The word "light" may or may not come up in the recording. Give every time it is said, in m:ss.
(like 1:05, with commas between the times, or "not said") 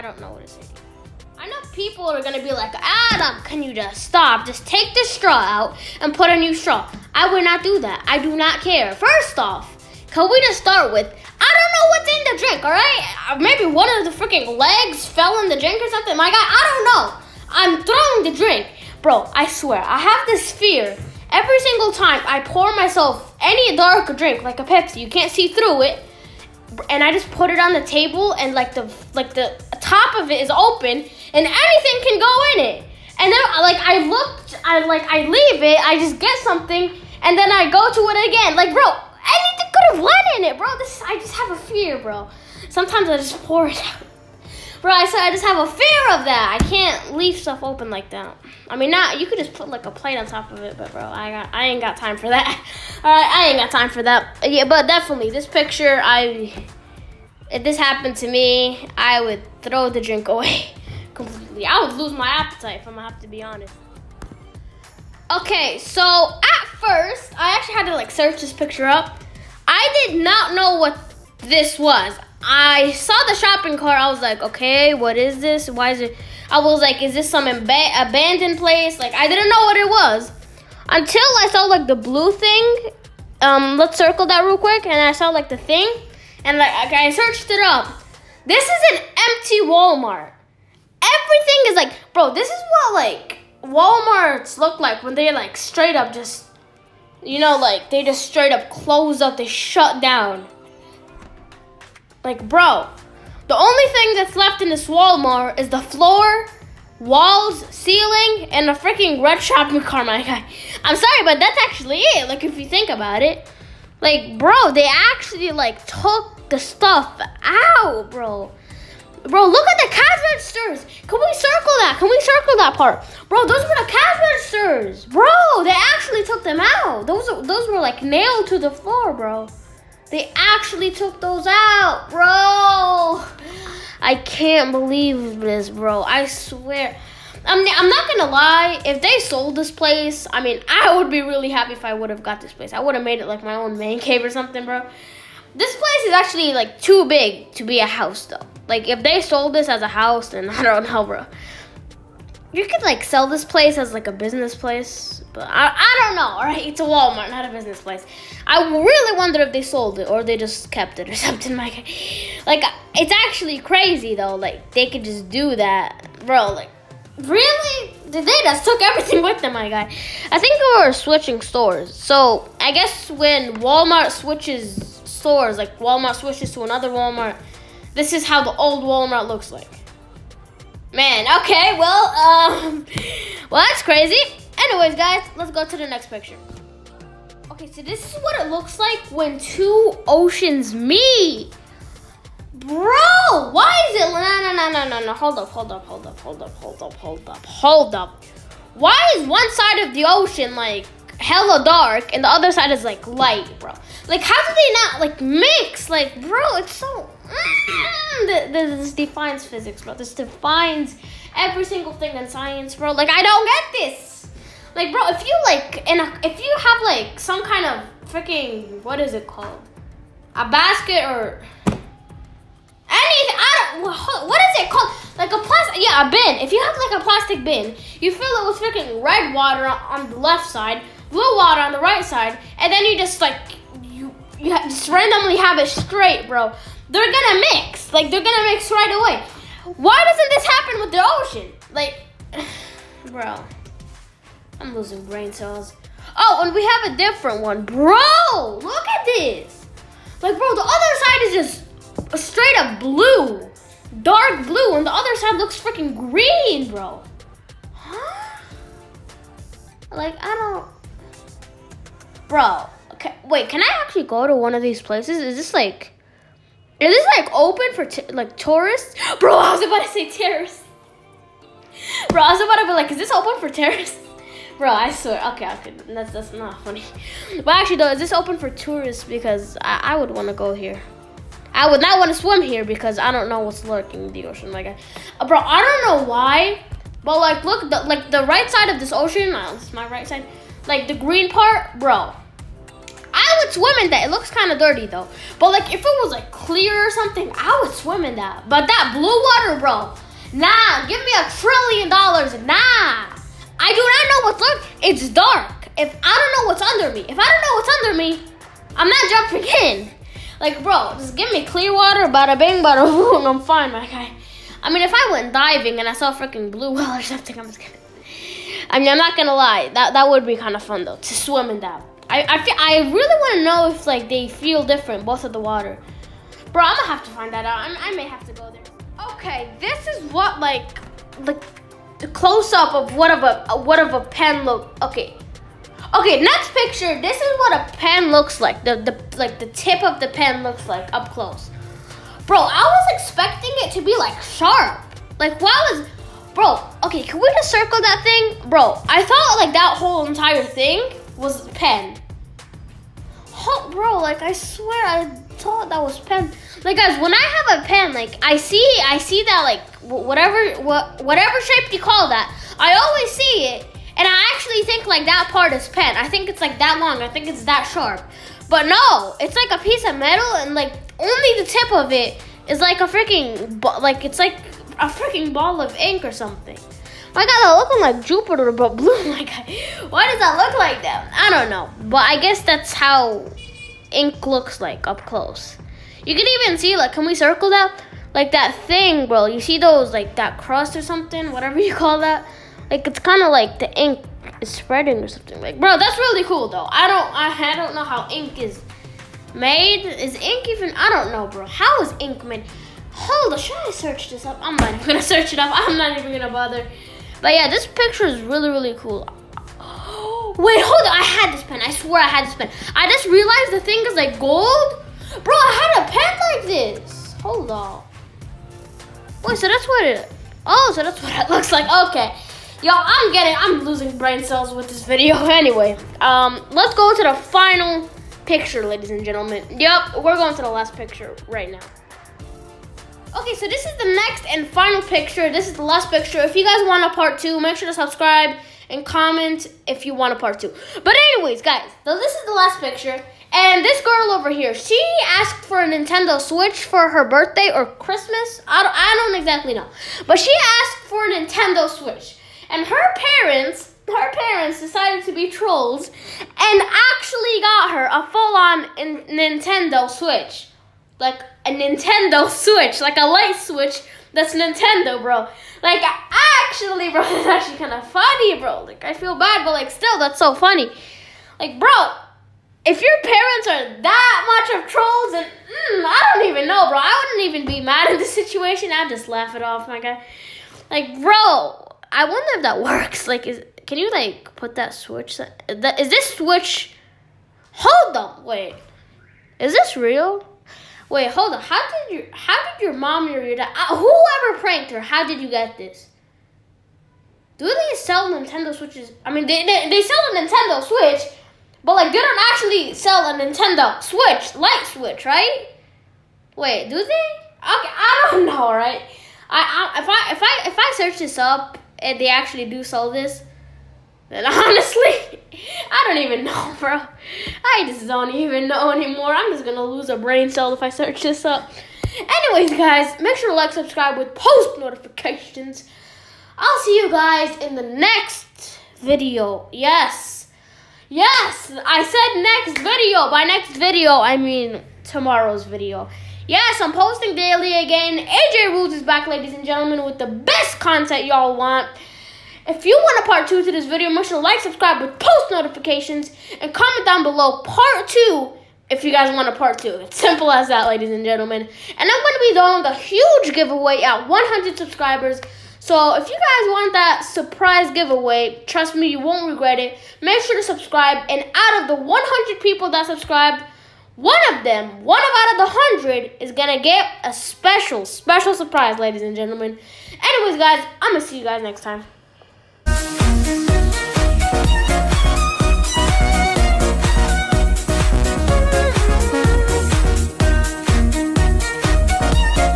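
3:23, 7:43, 8:24.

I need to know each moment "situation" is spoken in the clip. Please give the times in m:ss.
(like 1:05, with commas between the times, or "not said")
7:58.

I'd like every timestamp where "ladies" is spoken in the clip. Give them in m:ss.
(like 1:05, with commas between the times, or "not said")
7:08, 8:59, 9:10, 9:28.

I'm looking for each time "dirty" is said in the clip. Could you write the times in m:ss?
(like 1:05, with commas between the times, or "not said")
4:54.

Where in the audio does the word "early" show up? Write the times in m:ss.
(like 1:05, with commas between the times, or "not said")
not said.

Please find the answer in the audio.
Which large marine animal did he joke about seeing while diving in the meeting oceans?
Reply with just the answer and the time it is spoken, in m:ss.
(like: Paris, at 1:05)
Blue whale, at 5:16.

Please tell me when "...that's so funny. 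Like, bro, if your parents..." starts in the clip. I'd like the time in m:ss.
7:49.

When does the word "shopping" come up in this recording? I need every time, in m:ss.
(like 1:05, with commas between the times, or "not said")
1:13, 1:49.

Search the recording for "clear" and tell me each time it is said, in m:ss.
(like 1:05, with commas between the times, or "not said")
4:56, 5:11.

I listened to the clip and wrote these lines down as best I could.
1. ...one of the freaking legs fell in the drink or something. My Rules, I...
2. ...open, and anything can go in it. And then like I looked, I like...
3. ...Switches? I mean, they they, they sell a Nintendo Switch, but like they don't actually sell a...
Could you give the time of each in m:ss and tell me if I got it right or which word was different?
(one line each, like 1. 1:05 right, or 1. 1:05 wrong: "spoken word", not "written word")
1. 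0:13 wrong: "God", not "Rules"
2. 0:30 right
3. 8:18 right.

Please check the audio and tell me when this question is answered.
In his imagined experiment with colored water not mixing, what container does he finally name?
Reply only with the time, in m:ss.
3:46.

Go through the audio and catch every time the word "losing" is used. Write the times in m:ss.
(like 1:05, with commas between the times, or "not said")
4:04, 7:03.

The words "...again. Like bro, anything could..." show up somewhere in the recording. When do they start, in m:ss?
0:38.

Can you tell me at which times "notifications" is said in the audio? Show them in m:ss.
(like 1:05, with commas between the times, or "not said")
8:44, 9:05.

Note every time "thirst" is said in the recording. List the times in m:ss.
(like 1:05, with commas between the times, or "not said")
not said.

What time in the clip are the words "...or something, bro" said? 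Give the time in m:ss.
2:24.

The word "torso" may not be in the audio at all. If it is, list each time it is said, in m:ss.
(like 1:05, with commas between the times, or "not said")
not said.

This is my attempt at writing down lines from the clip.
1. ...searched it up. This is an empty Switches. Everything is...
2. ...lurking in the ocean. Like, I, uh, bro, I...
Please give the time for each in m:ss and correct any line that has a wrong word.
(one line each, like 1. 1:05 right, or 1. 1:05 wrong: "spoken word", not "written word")
1. 1:27 wrong: "Walmart", not "Switches"
2. 4:43 right.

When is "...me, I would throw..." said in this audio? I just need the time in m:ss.
0:58.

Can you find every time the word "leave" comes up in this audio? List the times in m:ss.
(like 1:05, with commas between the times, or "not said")
0:35, 0:47.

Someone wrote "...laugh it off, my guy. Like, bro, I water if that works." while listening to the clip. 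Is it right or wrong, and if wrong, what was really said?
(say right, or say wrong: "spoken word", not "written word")
wrong: "wonder", not "water".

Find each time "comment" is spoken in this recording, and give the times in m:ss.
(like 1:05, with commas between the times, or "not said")
7:18, 9:06.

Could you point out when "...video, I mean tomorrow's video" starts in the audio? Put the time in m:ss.
8:53.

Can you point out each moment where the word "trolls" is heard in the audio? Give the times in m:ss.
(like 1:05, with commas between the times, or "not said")
7:35, 7:54.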